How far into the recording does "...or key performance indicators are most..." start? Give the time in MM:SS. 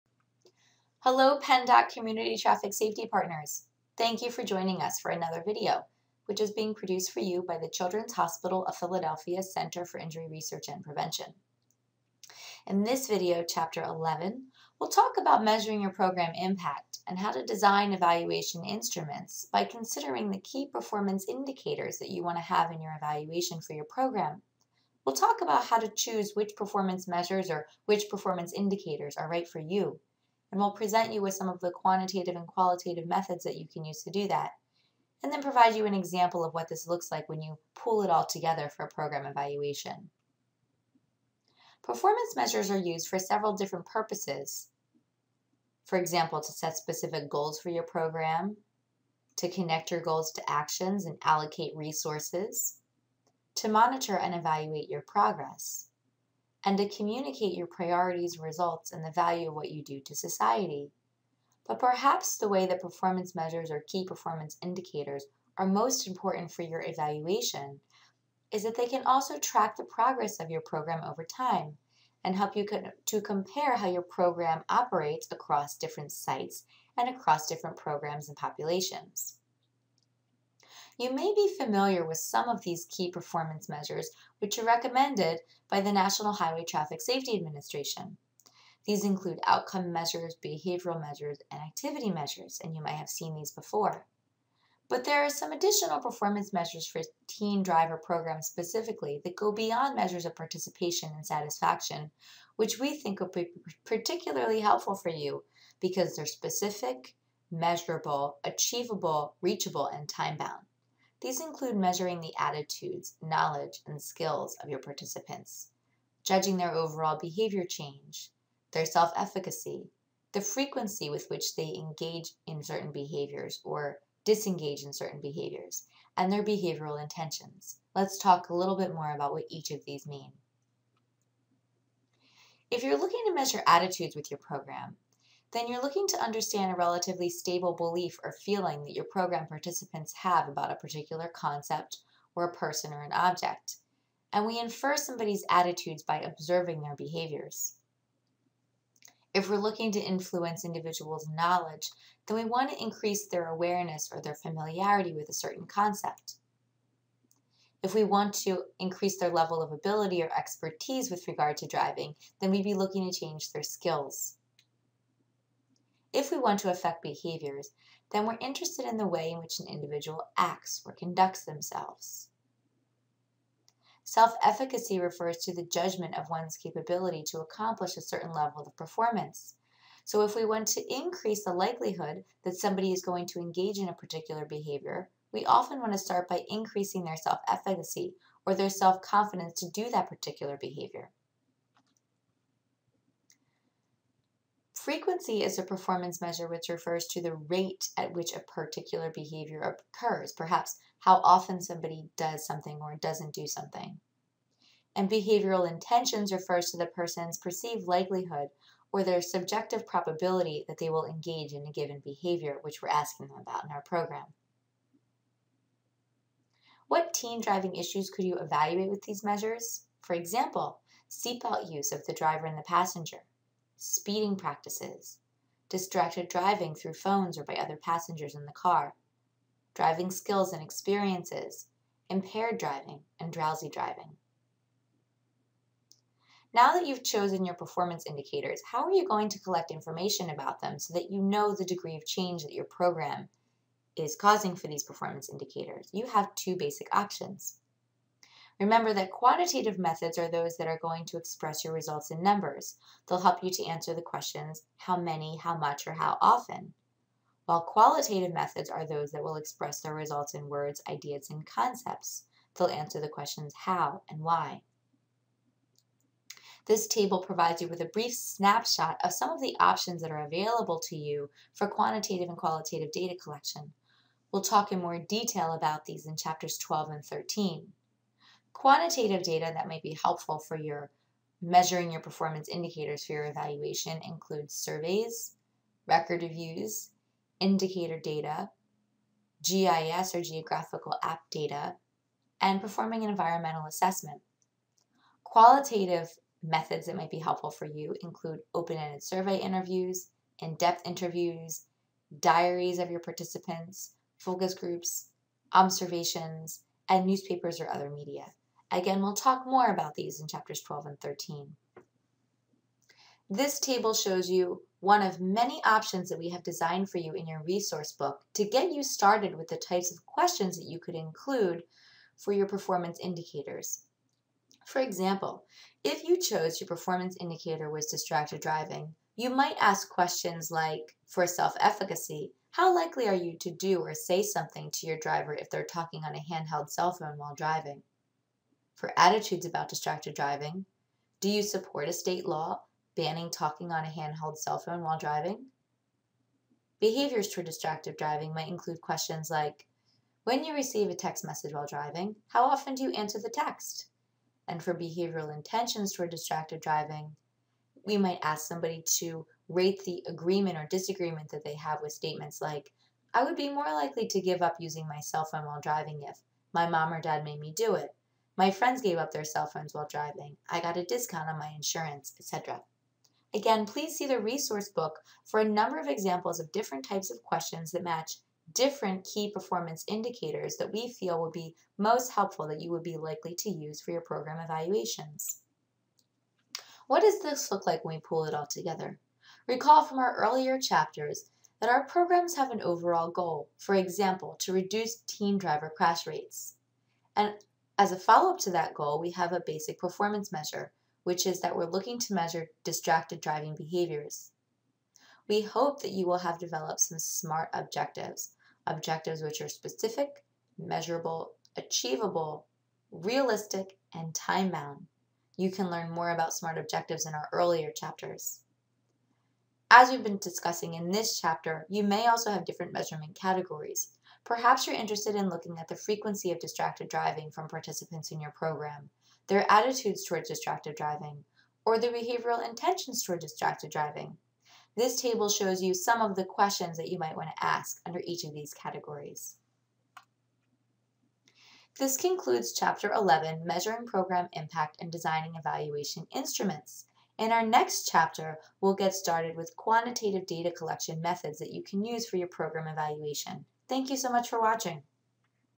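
01:03.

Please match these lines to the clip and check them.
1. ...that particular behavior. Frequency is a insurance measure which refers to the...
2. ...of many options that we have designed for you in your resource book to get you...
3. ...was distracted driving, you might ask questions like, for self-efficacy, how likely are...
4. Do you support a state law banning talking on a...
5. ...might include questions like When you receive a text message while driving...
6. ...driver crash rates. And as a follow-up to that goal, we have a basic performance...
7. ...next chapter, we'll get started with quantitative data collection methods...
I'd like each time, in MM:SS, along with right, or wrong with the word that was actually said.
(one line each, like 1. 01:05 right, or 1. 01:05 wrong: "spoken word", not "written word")
1. 03:09 wrong: "performance", not "insurance"
2. 05:15 right
3. 05:27 right
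4. 05:41 right
5. 05:48 right
6. 06:35 right
7. 07:27 right.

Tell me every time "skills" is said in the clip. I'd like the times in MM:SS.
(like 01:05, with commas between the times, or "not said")
01:54, 02:43, 03:50.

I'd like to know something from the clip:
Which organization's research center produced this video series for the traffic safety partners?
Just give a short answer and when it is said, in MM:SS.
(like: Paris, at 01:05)
Children's Hospital of Philadelphia, at 00:07.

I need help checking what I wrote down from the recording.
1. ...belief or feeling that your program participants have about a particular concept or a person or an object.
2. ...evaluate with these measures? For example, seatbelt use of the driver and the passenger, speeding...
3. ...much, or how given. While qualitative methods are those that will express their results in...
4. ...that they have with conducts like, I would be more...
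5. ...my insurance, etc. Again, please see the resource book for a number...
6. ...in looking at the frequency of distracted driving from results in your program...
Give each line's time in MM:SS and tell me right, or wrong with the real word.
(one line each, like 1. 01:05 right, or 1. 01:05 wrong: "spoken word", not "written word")
1. 02:17 right
2. 03:38 right
3. 04:15 wrong: "often", not "given"
4. 06:01 wrong: "statements", not "conducts"
5. 06:11 right
6. 07:05 wrong: "participants", not "results".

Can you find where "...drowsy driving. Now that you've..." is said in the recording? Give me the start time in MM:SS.
03:53.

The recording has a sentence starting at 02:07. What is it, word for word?
Let's talk a little bit more about what each of these mean.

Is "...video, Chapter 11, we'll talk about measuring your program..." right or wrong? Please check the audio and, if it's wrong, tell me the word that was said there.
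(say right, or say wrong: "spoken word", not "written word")
right.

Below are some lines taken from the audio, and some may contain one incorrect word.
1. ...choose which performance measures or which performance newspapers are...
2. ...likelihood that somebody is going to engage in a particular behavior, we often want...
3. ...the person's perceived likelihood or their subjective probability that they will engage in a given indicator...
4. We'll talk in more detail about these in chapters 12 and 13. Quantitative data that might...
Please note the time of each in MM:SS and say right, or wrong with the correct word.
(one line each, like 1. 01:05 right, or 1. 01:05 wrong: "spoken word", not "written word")
1. 00:25 wrong: "indicators", not "newspapers"
2. 03:01 right
3. 03:26 wrong: "behavior", not "indicator"
4. 04:34 right.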